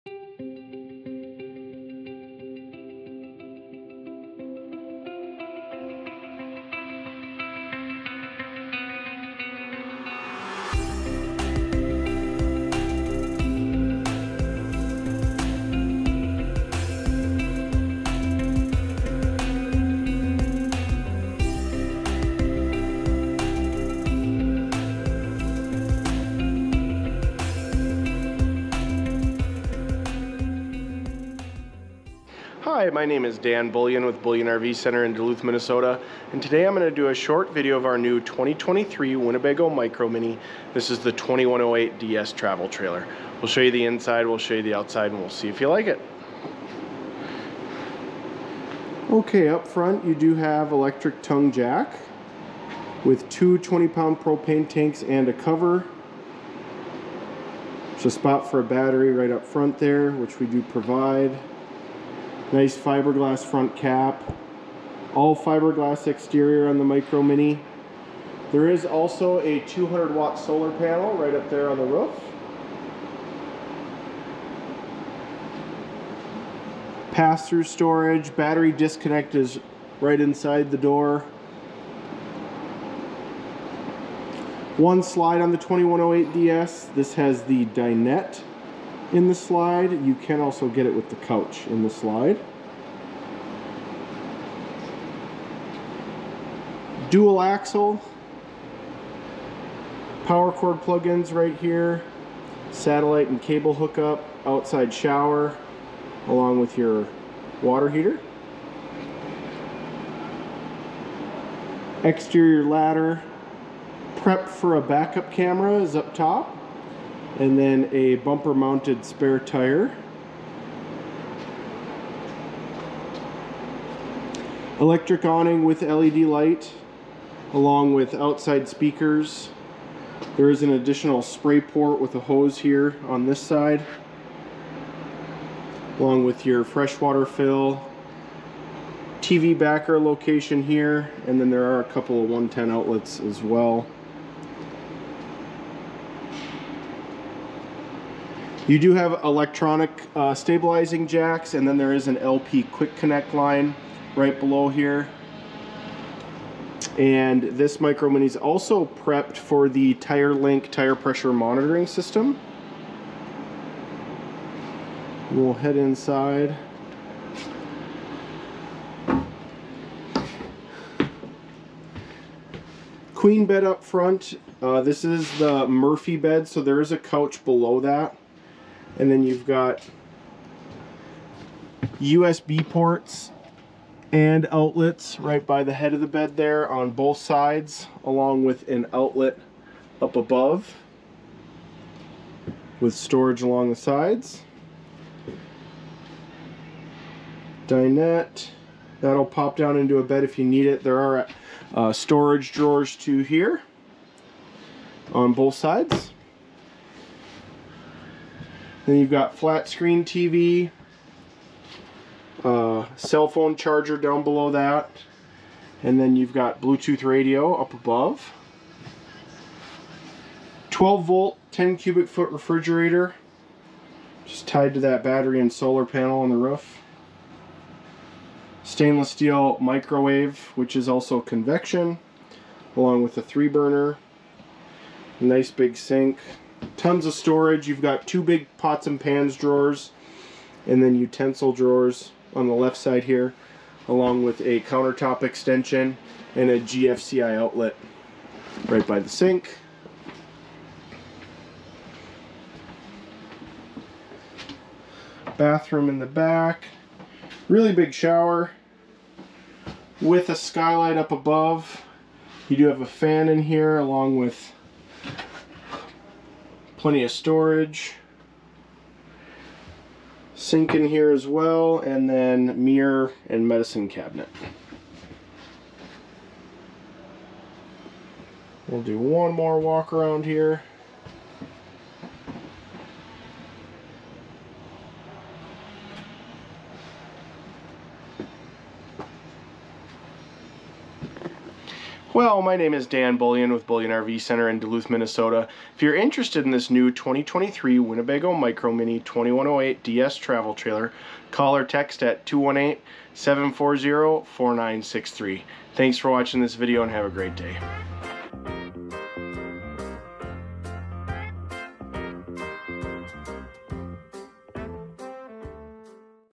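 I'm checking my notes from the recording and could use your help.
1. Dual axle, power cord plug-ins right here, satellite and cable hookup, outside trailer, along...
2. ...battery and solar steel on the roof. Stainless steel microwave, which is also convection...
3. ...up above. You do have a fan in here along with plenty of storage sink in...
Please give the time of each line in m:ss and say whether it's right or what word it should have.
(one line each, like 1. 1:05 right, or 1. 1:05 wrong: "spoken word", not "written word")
1. 1:37 wrong: "shower", not "trailer"
2. 3:45 wrong: "panel", not "steel"
3. 4:20 right.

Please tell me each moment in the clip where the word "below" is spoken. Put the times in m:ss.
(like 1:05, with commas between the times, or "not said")
2:34, 2:57, 3:34.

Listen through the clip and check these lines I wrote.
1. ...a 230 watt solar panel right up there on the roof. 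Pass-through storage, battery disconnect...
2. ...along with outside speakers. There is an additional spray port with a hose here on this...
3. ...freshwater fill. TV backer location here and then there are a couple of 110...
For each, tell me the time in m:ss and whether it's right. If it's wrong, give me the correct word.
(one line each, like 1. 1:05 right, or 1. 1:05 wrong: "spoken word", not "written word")
1. 1:09 wrong: "200", not "230"
2. 2:07 right
3. 2:16 right.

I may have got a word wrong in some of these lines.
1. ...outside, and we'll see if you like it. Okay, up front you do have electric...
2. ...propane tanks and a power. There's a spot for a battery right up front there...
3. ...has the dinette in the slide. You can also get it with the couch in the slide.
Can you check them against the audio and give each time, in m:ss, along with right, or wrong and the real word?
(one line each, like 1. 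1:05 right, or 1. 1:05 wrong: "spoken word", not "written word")
1. 0:44 right
2. 0:54 wrong: "cover", not "power"
3. 1:27 right.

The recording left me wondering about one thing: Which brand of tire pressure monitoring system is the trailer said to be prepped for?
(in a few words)
TireLinc.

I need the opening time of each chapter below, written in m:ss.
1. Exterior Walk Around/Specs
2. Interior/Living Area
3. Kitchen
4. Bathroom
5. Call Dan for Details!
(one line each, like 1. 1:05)
1. 0:45
2. 2:46
3. 3:39
4. 4:11
5. 4:51.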